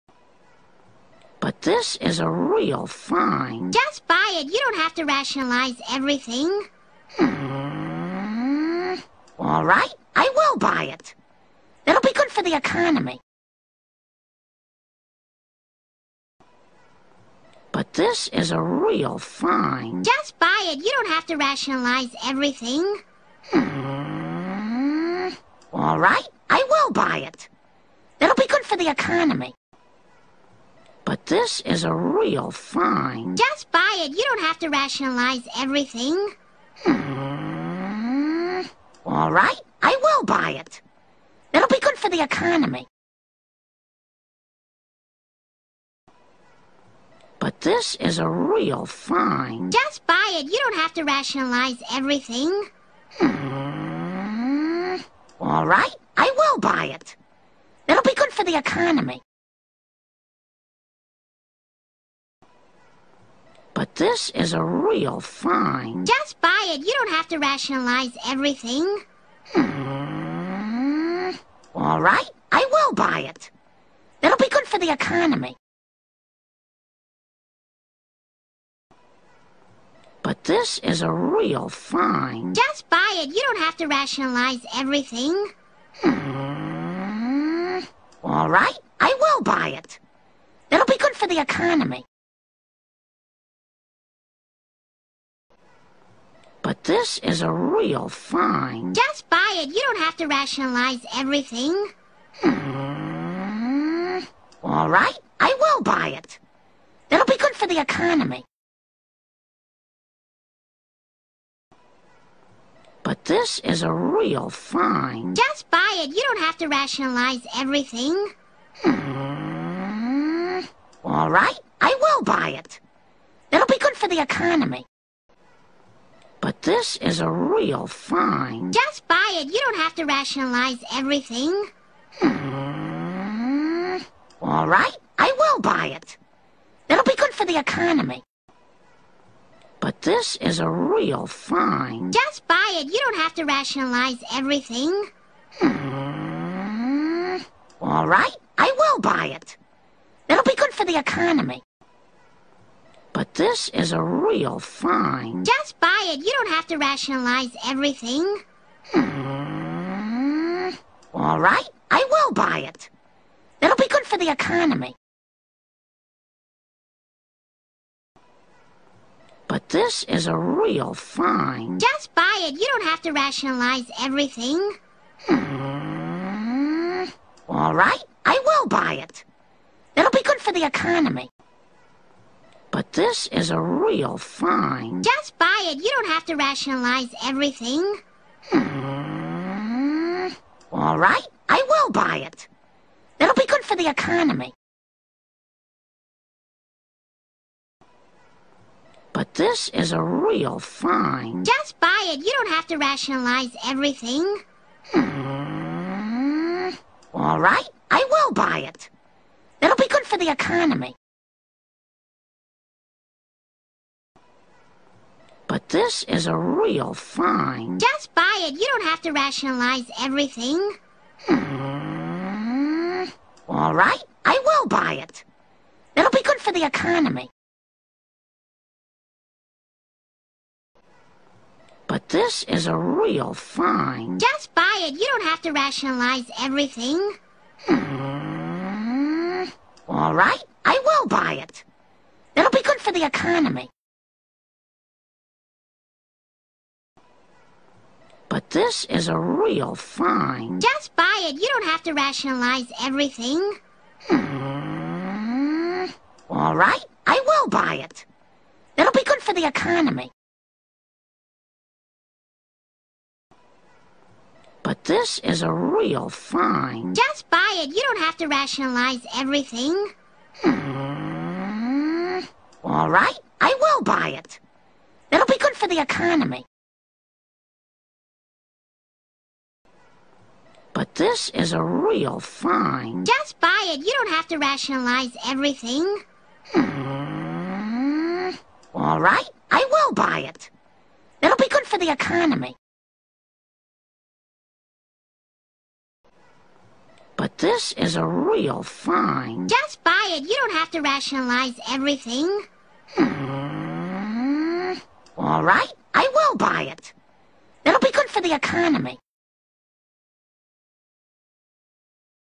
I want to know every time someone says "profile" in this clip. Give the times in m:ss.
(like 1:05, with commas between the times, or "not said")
not said.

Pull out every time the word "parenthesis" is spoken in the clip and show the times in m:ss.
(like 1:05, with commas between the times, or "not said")
not said.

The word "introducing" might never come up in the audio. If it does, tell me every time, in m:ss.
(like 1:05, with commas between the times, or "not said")
not said.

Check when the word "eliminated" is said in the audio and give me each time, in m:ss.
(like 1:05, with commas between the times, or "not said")
not said.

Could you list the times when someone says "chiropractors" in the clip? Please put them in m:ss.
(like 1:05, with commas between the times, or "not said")
not said.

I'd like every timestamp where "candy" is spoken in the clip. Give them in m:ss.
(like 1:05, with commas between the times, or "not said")
not said.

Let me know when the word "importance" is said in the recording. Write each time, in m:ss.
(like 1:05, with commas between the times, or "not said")
not said.